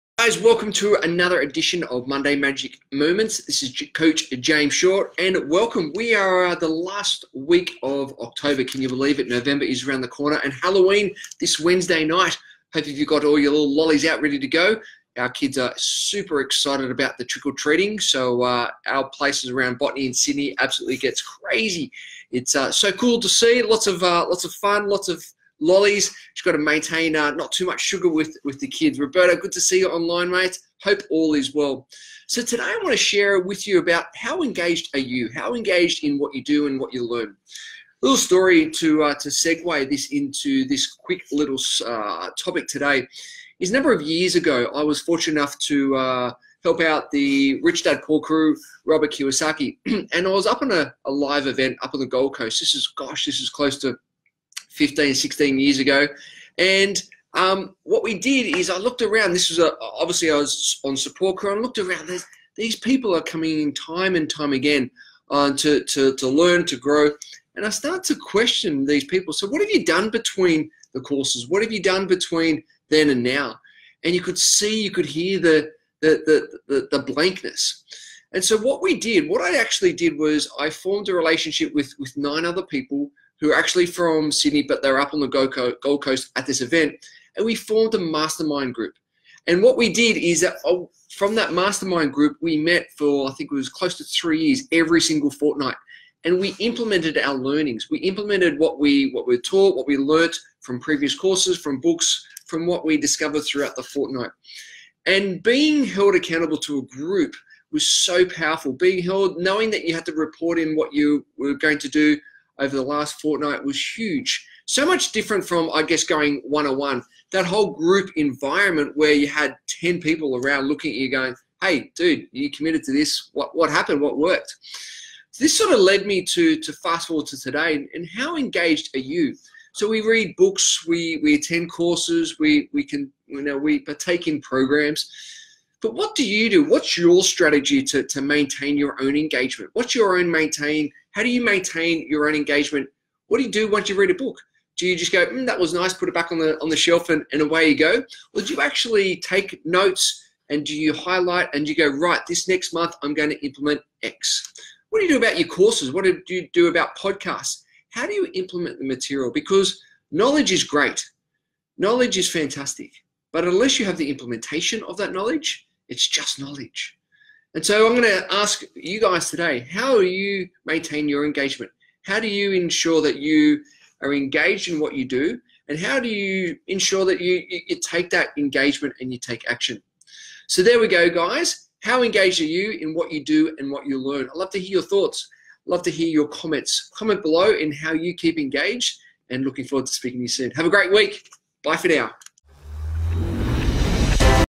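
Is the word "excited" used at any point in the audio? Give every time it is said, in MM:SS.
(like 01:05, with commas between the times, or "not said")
00:16.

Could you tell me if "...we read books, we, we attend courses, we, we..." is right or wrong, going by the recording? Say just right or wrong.
right.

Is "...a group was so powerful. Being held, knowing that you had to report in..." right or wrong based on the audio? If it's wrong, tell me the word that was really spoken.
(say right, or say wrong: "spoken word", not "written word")
right.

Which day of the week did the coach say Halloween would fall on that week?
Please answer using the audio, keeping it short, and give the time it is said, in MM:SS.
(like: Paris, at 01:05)
Wednesday, at 00:11.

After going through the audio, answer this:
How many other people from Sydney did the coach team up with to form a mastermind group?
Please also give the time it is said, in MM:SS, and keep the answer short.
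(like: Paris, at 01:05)
9, at 01:22.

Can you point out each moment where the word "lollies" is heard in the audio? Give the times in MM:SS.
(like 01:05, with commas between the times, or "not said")
00:13, 00:25.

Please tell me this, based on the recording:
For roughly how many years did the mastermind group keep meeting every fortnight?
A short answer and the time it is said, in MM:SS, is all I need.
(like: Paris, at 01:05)
3, at 01:34.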